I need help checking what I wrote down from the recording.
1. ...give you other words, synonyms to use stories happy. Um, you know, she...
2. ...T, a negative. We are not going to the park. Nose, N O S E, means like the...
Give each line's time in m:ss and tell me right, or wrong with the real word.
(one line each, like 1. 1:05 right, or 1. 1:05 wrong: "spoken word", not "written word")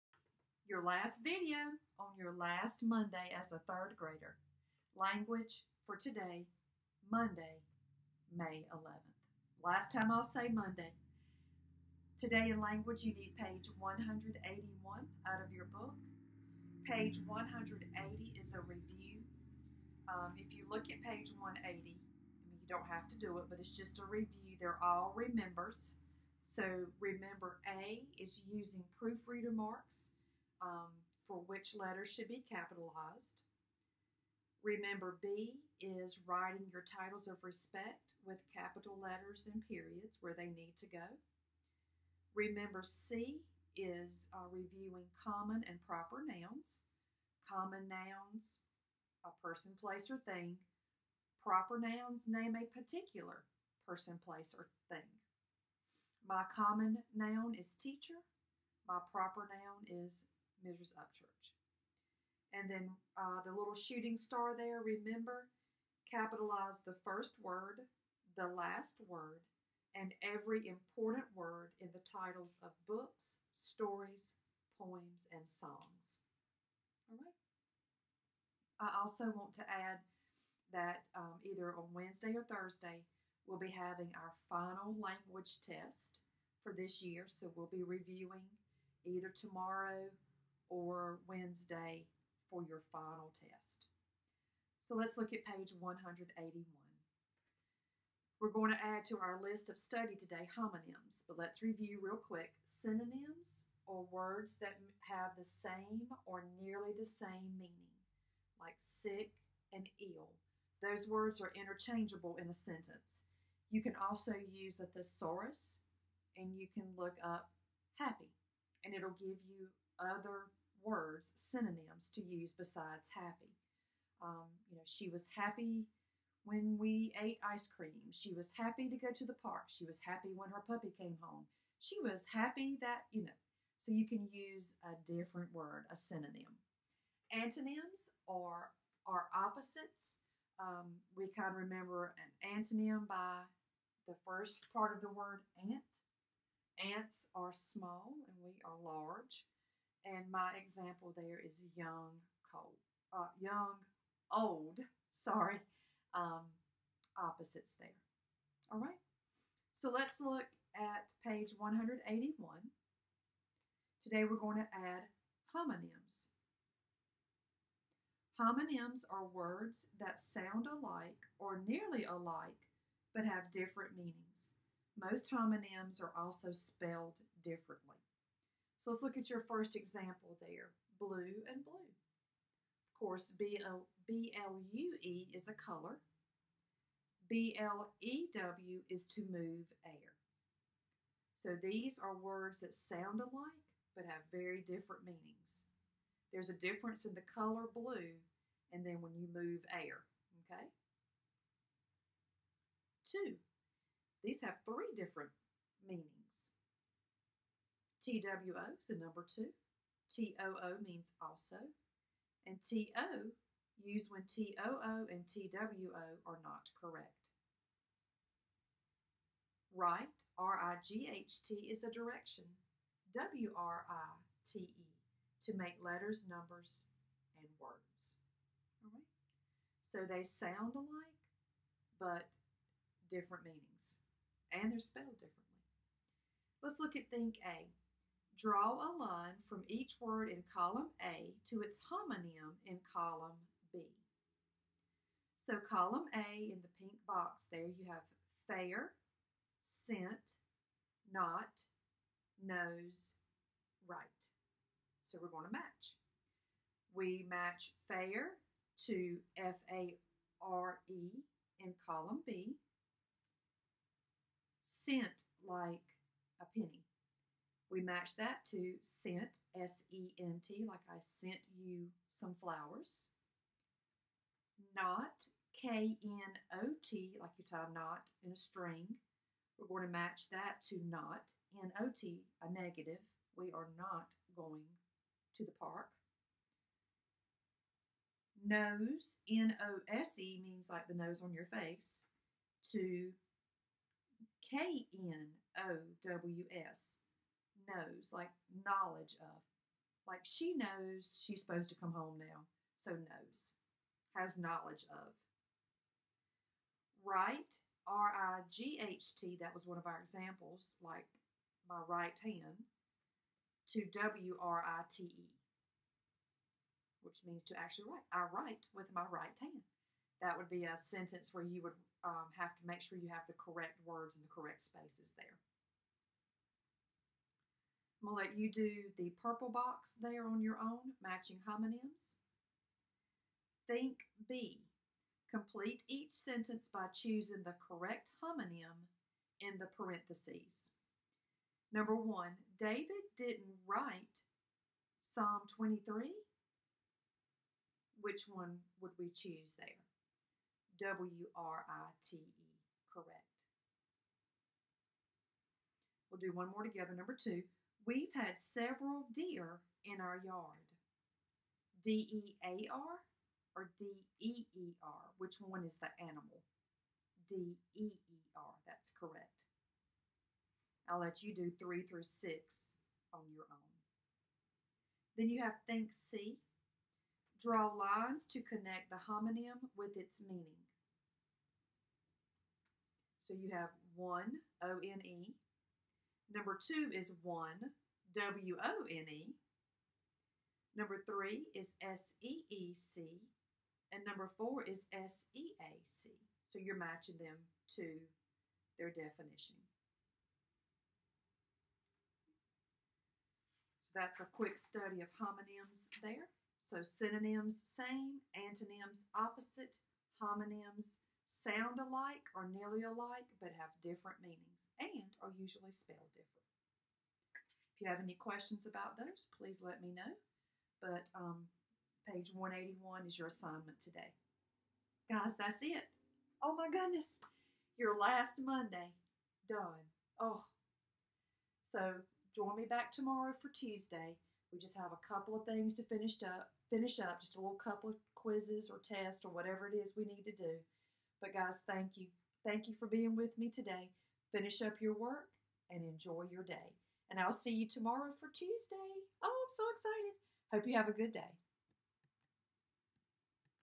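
1. 1:59 wrong: "besides", not "stories"
2. 4:41 right.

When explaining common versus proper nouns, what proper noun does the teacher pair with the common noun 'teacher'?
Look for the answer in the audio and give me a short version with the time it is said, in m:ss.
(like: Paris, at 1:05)
Mrs. Upchurch, at 1:00.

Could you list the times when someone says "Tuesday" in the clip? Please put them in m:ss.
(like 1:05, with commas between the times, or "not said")
7:13, 7:28.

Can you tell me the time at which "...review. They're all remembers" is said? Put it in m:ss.
0:24.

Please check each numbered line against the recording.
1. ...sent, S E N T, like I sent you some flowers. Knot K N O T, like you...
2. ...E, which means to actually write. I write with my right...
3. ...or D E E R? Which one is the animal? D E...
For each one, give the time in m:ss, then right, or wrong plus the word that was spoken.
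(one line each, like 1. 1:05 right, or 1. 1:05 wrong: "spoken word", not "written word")
1. 4:28 right
2. 5:15 right
3. 6:03 right.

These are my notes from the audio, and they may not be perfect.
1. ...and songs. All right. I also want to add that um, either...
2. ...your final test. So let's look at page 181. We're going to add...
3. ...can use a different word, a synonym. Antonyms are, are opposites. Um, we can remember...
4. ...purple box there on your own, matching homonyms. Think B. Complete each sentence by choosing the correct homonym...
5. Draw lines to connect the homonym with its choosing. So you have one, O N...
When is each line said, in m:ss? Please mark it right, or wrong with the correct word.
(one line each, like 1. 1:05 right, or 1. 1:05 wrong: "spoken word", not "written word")
1. 1:15 right
2. 1:32 right
3. 2:14 right
4. 5:29 right
5. 6:17 wrong: "meaning", not "choosing".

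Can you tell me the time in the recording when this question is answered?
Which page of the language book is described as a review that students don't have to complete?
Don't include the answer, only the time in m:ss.
0:16.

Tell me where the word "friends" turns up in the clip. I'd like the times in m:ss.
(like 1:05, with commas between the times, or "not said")
not said.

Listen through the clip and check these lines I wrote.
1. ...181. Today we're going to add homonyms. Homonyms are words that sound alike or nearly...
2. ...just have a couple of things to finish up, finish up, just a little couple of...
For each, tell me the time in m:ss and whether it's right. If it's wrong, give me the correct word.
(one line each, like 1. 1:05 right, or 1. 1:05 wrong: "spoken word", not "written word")
1. 2:41 right
2. 7:14 right.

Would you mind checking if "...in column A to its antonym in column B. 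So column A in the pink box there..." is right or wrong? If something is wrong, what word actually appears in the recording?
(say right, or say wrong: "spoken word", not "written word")
wrong: "homonym", not "antonym".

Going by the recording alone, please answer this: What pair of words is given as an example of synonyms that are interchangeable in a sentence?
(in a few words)
sick and ill.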